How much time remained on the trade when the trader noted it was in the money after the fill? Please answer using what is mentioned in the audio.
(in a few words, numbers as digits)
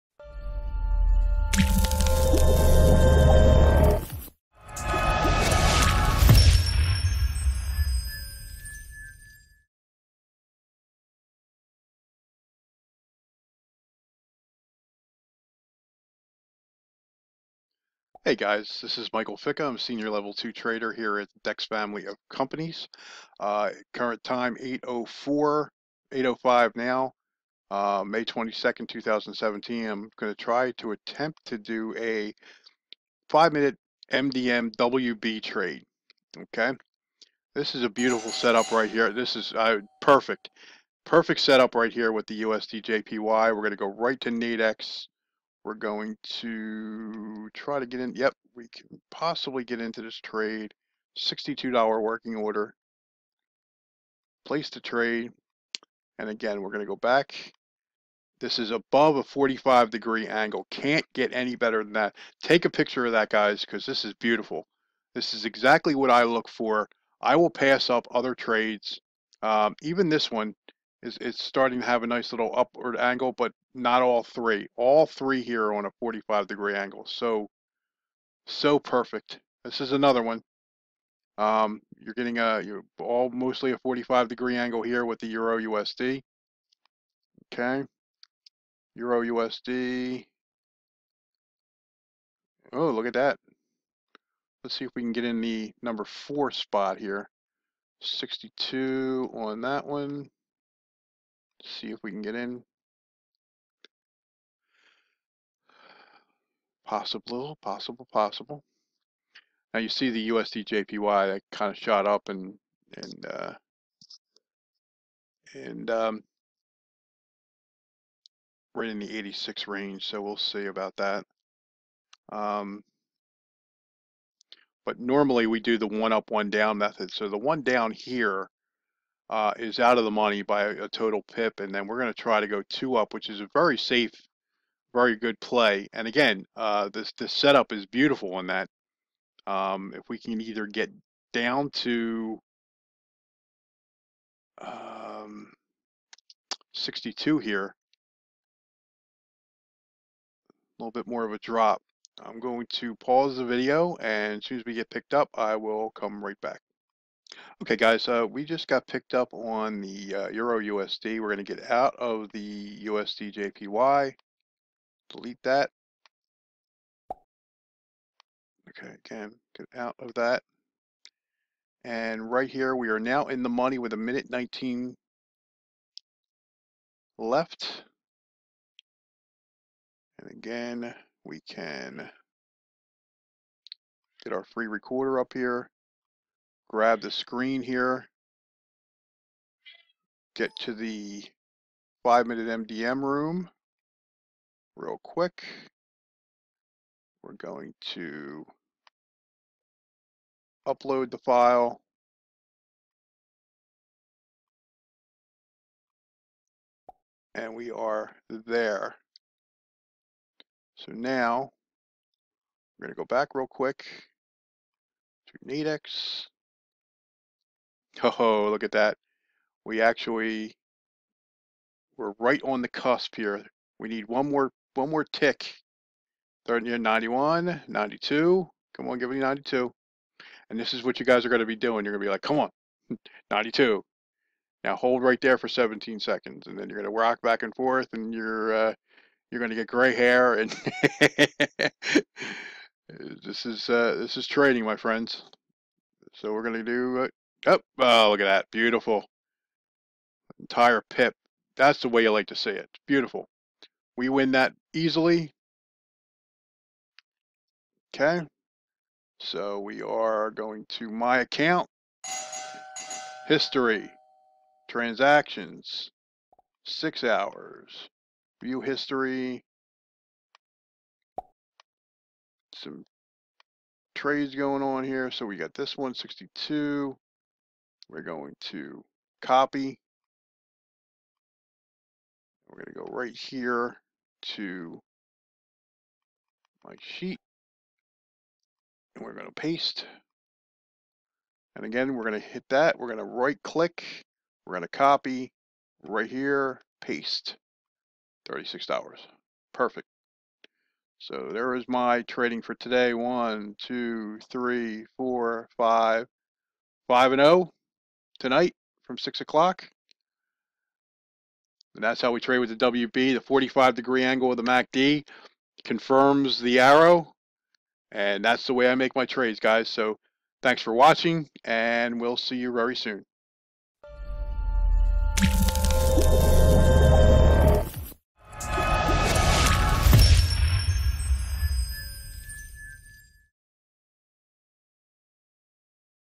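1 minute 19.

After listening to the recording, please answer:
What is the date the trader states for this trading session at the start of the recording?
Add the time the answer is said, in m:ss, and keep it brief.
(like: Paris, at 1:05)
May 22nd, 2017, at 0:28.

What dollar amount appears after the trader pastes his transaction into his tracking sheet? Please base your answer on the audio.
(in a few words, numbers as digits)
$36.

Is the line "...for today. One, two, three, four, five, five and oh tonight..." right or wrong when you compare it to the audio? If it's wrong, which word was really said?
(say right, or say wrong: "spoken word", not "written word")
right.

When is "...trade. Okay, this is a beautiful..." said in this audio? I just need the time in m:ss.
0:35.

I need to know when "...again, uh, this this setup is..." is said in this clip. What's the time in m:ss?
2:16.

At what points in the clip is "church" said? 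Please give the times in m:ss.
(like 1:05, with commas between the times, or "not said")
not said.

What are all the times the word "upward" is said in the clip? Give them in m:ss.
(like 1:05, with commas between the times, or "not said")
1:12.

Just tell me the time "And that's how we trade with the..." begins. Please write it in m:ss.
5:11.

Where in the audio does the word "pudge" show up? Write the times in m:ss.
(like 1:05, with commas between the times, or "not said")
not said.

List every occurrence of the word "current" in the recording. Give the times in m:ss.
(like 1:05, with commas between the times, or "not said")
0:23.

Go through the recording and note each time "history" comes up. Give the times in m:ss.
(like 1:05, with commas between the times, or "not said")
4:23, 4:28.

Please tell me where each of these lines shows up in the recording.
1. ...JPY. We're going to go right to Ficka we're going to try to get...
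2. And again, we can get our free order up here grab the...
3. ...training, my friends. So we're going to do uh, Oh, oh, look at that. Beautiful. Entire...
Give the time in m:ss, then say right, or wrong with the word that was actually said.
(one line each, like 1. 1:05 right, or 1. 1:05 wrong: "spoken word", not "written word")
1. 0:42 wrong: "Nadex", not "Ficka"
2. 3:00 wrong: "recorder", not "order"
3. 4:04 right.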